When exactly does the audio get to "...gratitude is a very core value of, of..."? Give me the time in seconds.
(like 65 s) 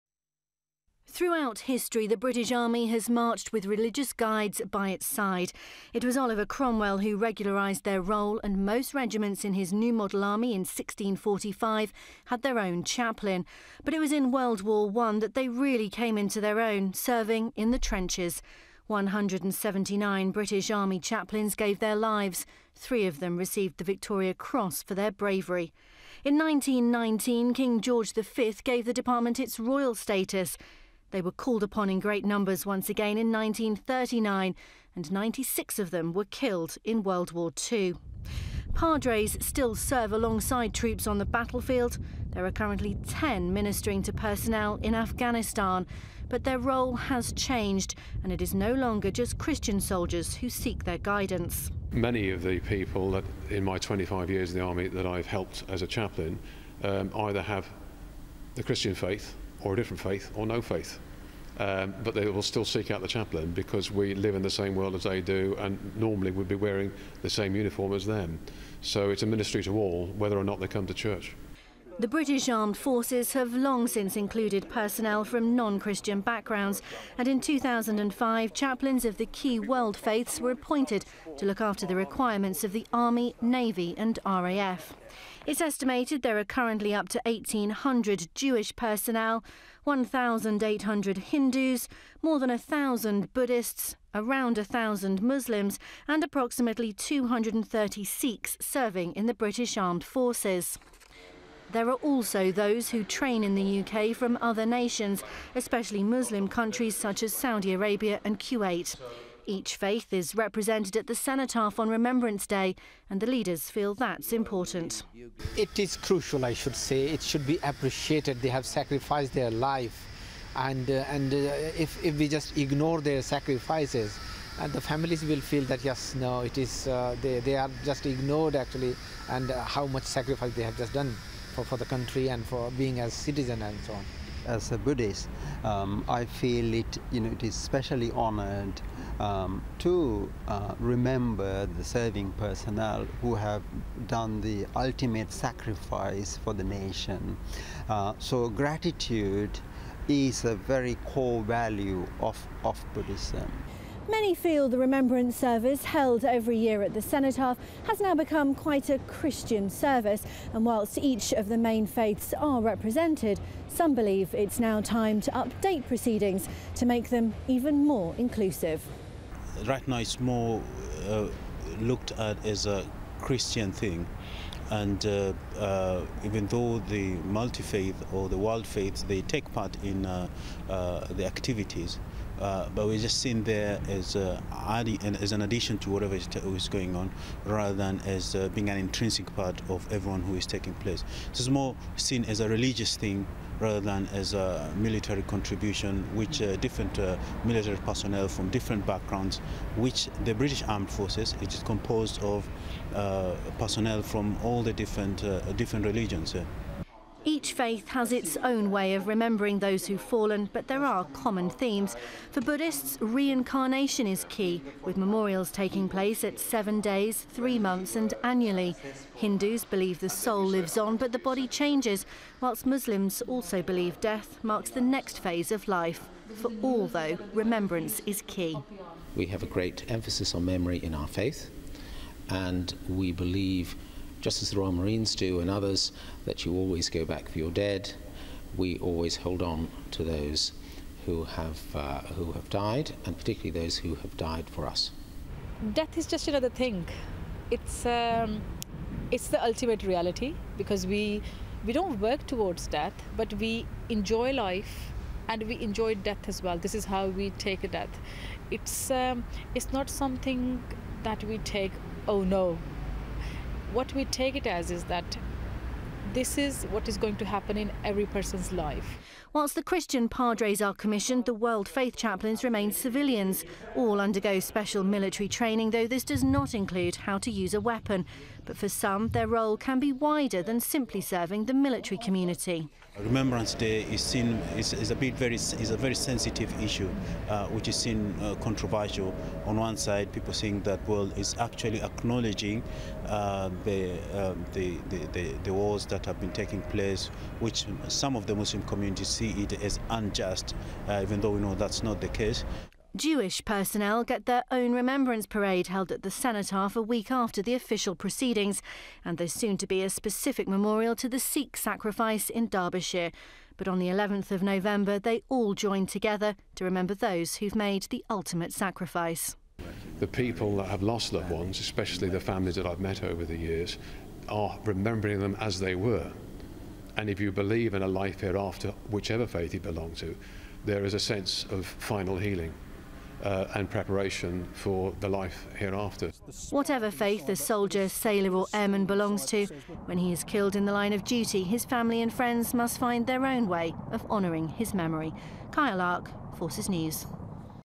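148 s.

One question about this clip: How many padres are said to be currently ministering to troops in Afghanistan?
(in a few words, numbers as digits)
10.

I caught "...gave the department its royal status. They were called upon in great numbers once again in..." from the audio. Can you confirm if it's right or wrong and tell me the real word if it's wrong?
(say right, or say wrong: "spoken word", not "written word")
right.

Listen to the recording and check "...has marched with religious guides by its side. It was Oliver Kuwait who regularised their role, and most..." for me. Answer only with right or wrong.
wrong.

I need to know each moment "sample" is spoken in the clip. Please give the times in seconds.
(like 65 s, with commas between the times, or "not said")
not said.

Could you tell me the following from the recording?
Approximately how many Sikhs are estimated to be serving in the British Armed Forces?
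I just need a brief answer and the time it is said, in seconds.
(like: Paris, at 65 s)
230, at 96 s.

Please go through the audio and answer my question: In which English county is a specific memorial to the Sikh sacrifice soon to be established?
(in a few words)
Derbyshire.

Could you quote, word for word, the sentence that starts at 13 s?
But it was in World War I that they really came into their own, serving in the trenches.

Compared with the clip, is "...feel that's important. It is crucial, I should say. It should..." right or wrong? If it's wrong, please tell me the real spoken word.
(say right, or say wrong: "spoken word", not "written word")
right.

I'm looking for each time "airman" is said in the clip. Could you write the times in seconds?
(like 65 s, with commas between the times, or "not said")
338 s.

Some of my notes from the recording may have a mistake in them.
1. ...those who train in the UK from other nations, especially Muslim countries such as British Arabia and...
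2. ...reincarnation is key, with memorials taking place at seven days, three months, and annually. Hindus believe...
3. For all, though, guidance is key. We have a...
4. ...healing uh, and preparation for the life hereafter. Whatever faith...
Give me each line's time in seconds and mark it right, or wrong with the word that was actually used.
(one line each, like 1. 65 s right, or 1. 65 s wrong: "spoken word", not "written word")
1. 102 s wrong: "Saudi", not "British"
2. 212 s right
3. 226 s wrong: "remembrance", not "guidance"
4. 332 s right.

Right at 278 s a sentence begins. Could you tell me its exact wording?
But for some, their role can be wider than simply serving the military community.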